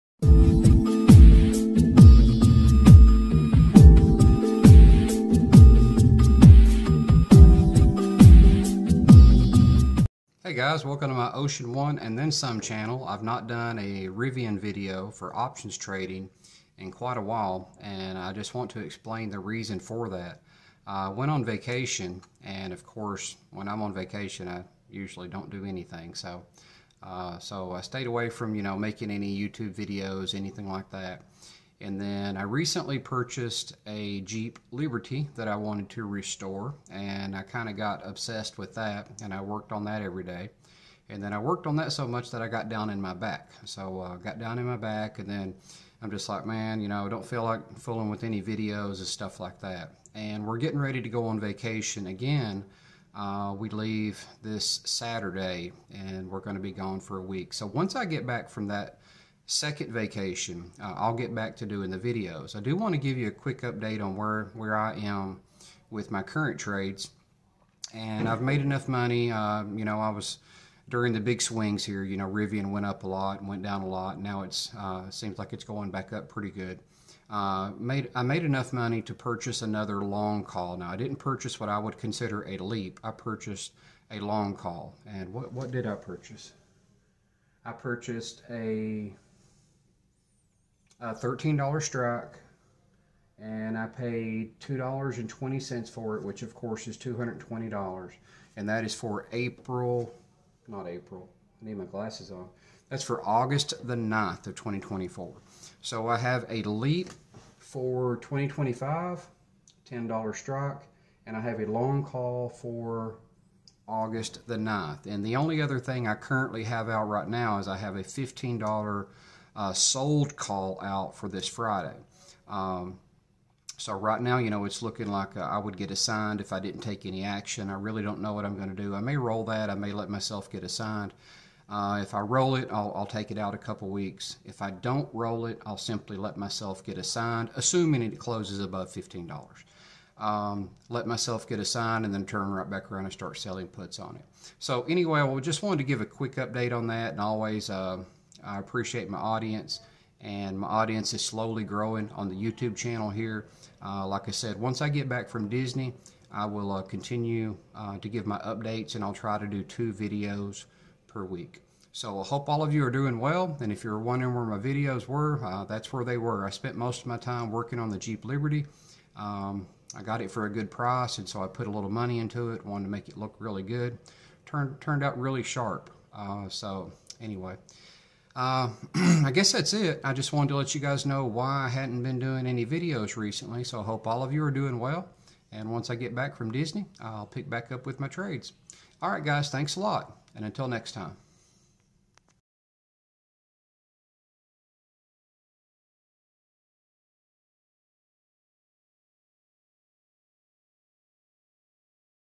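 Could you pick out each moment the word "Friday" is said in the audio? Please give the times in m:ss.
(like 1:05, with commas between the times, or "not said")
2:01.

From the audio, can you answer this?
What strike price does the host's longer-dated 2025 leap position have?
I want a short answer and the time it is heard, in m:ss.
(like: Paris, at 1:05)
$10, at 1:49.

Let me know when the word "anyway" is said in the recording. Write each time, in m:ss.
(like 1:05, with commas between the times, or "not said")
2:24, 2:57.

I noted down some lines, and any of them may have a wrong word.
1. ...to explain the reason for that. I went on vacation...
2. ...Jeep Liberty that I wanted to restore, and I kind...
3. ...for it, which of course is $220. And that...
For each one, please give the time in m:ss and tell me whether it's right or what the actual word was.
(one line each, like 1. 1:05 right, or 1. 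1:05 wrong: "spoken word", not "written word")
1. 0:18 right
2. 0:34 right
3. 1:35 right.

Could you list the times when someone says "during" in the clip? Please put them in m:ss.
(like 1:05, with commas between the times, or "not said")
1:10.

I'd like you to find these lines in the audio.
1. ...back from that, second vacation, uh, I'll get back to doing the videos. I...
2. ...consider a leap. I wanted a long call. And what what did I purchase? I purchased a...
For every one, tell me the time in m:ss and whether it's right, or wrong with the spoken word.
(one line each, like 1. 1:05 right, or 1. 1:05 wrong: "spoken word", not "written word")
1. 0:58 right
2. 1:21 wrong: "purchased", not "wanted".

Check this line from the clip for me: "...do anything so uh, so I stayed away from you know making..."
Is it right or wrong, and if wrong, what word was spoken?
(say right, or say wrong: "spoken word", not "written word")
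right.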